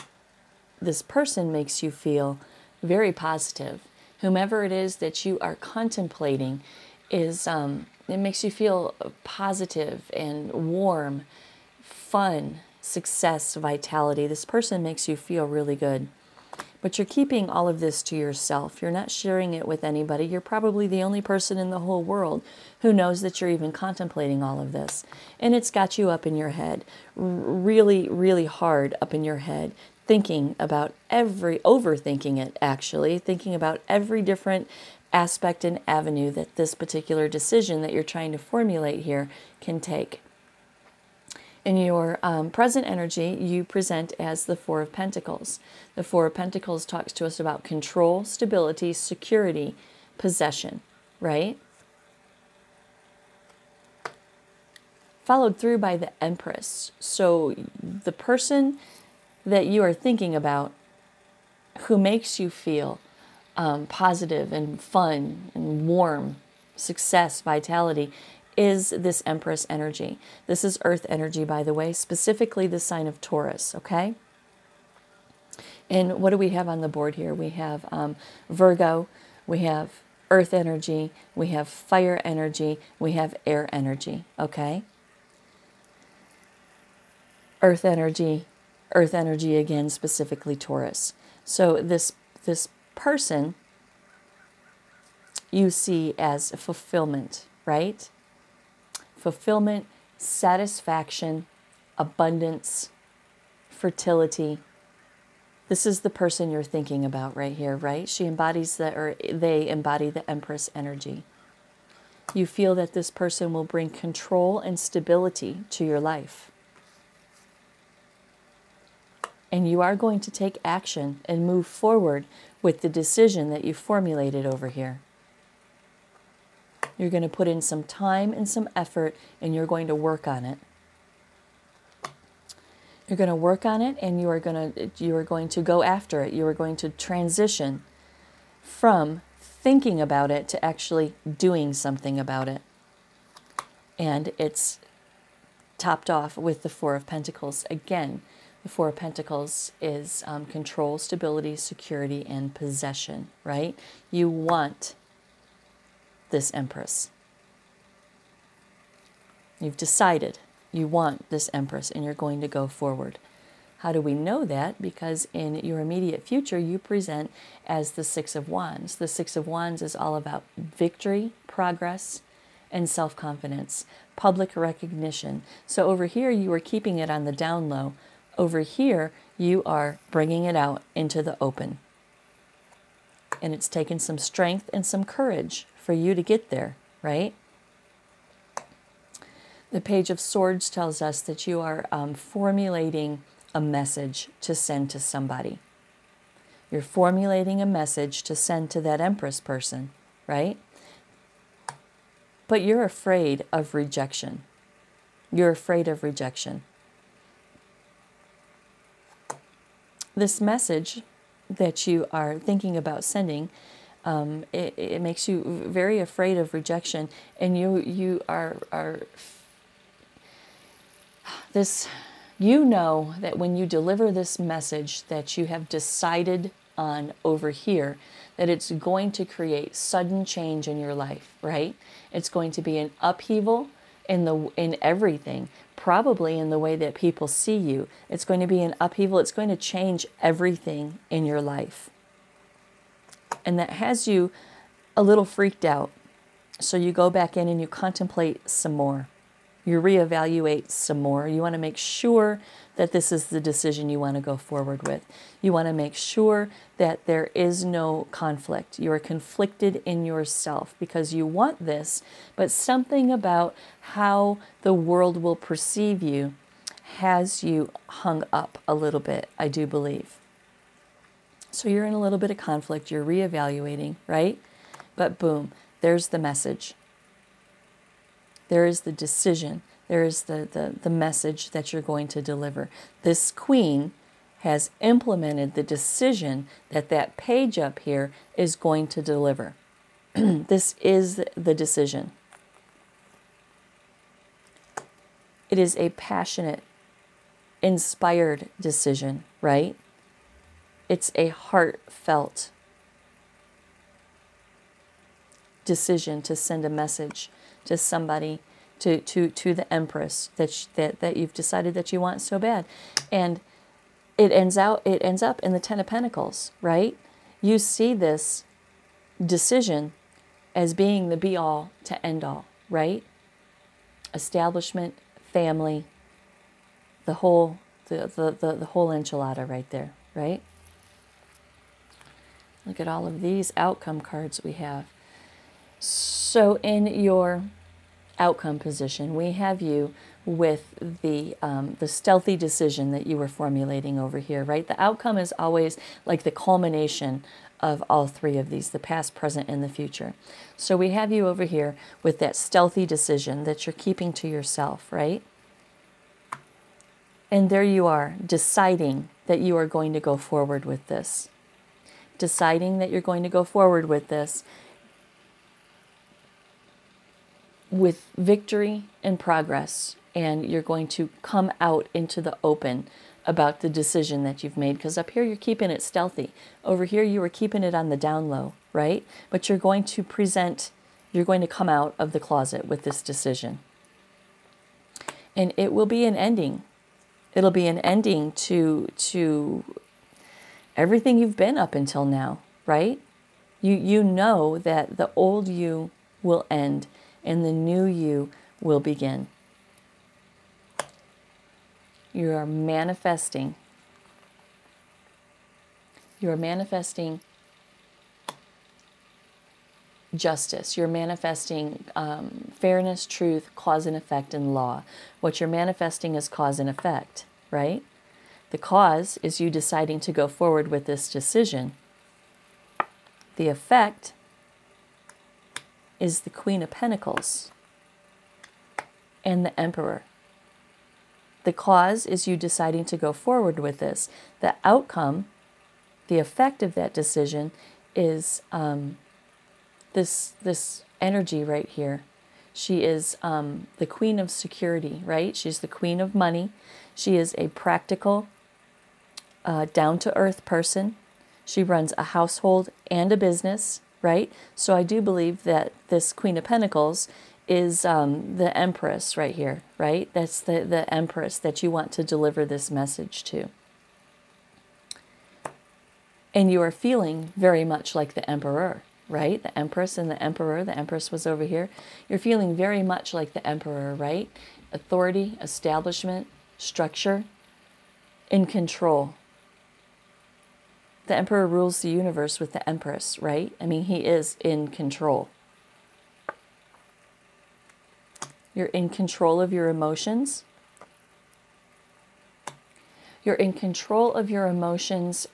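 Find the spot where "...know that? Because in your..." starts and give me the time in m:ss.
2:44.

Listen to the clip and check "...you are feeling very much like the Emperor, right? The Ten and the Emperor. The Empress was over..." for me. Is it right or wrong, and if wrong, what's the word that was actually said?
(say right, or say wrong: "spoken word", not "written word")
wrong: "Empress", not "Ten".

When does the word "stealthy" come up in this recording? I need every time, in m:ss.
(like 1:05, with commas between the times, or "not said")
5:41, 5:52, 6:15.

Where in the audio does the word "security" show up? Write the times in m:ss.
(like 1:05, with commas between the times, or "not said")
0:48, 2:31, 7:24.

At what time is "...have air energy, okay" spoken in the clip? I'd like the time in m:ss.
1:23.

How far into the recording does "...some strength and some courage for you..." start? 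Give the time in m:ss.
3:03.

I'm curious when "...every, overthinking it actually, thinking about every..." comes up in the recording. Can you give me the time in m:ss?
0:31.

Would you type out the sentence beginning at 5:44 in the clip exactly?
The outcome is always like the culmination of all three of these, the past, present, and the future.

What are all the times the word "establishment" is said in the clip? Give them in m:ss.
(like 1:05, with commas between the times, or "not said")
5:24, 7:55.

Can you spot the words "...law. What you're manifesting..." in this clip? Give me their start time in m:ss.
6:54.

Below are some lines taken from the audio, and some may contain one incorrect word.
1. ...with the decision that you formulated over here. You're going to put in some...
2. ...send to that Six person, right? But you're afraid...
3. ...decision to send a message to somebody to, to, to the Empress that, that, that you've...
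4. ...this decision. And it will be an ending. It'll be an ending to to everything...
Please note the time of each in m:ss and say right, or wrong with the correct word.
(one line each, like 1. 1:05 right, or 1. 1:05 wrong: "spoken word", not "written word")
1. 2:02 right
2. 3:18 wrong: "Empress", not "Six"
3. 5:05 right
4. 6:22 right.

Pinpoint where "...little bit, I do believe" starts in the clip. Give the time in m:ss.
4:28.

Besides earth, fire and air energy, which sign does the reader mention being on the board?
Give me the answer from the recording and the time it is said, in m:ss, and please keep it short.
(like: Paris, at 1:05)
Virgo, at 1:18.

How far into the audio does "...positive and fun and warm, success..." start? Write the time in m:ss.
1:03.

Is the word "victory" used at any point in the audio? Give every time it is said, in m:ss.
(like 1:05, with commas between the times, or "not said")
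2:50, 6:08.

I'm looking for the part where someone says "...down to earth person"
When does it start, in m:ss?
7:29.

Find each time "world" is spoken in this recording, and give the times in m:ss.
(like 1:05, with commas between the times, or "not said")
0:22, 4:24.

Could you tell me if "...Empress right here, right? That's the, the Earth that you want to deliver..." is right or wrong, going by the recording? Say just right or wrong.
wrong.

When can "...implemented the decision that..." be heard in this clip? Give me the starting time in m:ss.
4:44.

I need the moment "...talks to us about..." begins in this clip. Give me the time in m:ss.
0:46.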